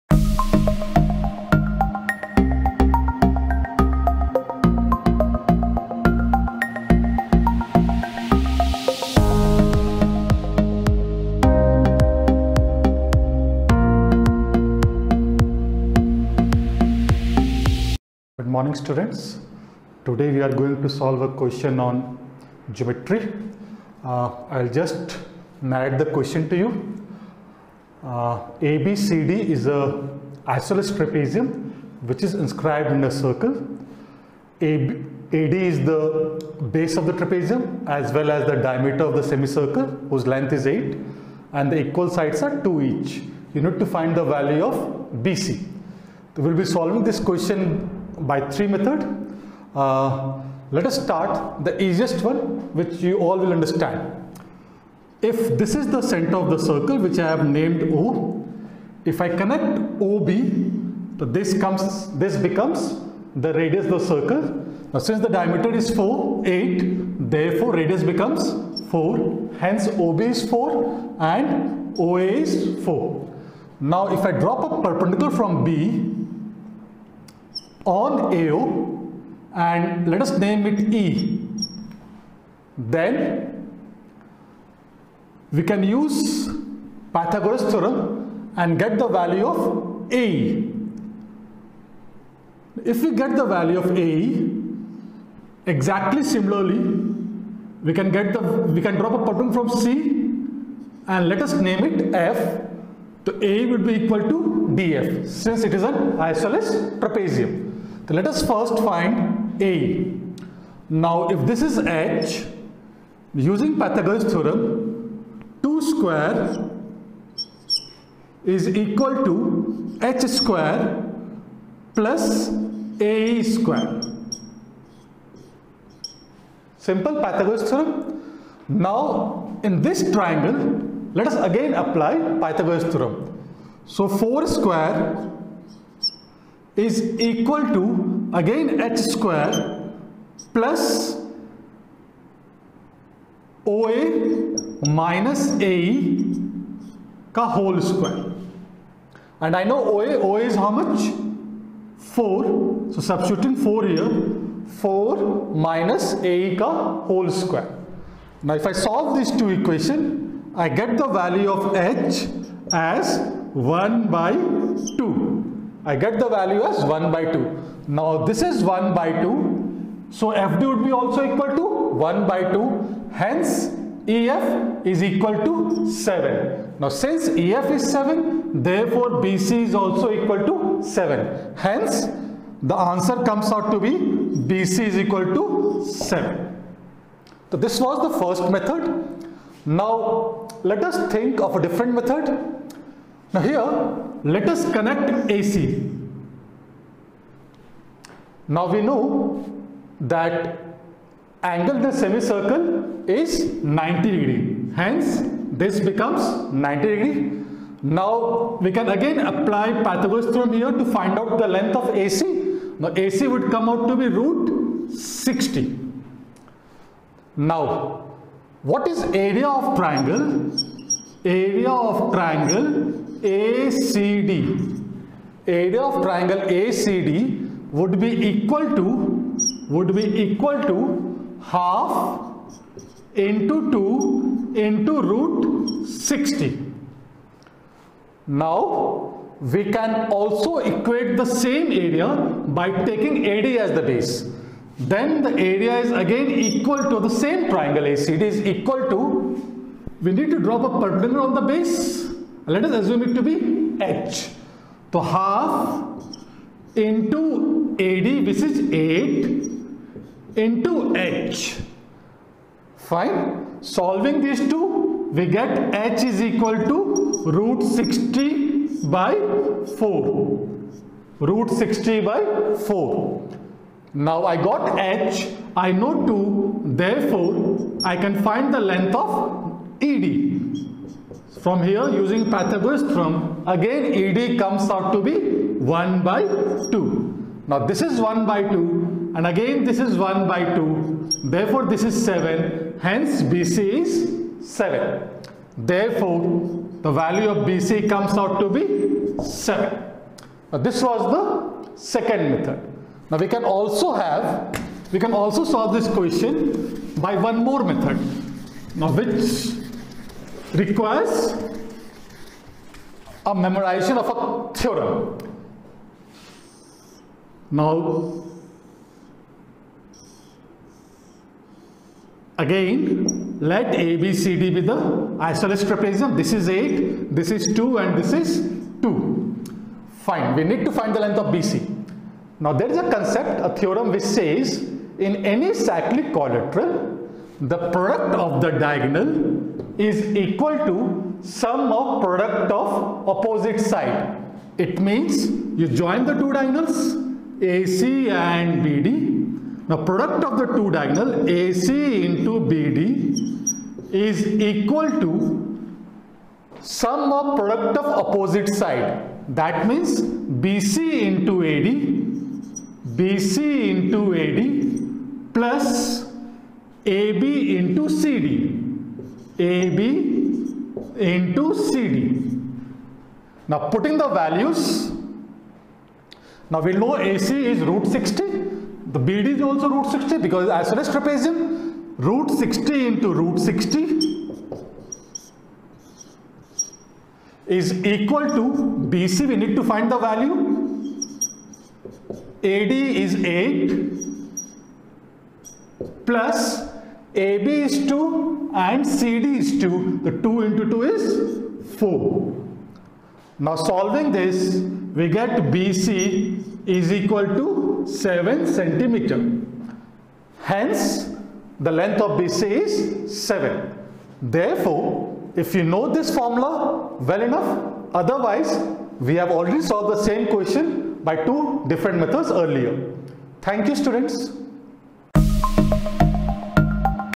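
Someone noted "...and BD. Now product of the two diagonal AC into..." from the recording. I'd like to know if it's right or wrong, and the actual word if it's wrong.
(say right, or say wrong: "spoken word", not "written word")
right.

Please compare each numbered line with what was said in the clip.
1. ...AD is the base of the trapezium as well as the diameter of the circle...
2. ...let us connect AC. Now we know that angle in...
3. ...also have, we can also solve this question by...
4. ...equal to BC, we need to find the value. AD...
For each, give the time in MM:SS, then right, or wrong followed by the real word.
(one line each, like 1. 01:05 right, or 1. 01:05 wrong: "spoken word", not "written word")
1. 00:35 wrong: "semicircle", not "circle"
2. 03:14 right
3. 05:03 right
4. 06:27 right.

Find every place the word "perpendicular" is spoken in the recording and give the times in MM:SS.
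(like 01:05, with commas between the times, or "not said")
01:14, 04:10.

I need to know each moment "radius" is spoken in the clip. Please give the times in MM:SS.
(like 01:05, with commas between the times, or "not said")
01:03, 01:07.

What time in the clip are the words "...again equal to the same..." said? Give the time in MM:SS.
04:05.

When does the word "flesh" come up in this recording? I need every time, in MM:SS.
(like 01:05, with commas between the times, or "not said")
not said.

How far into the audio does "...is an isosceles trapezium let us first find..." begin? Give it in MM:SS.
01:45.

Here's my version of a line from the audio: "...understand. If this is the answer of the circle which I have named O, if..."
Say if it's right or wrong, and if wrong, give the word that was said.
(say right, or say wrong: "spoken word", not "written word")
wrong: "center", not "answer".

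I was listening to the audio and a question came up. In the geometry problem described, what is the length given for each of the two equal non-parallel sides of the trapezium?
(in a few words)
2.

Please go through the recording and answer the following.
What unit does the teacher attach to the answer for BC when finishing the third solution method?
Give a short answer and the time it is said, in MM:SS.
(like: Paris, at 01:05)
centimeter, at 06:48.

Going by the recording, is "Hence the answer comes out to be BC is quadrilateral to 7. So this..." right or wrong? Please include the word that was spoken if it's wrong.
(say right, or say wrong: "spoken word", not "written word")
wrong: "equal", not "quadrilateral".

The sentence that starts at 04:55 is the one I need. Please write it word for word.
Therefore the value of BC comes out to be 7.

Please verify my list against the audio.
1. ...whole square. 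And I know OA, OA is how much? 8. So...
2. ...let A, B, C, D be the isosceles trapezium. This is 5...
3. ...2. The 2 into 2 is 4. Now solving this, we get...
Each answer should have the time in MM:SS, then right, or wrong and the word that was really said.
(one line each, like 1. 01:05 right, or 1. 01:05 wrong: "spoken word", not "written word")
1. 02:27 wrong: "4", not "8"
2. 05:23 wrong: "8", not "5"
3. 06:39 right.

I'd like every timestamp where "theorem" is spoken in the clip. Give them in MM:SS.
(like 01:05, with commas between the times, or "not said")
01:27, 01:54, 02:07, 02:12, 03:30, 04:42, 05:14, 05:33.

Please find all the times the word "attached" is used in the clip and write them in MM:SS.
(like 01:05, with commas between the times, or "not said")
not said.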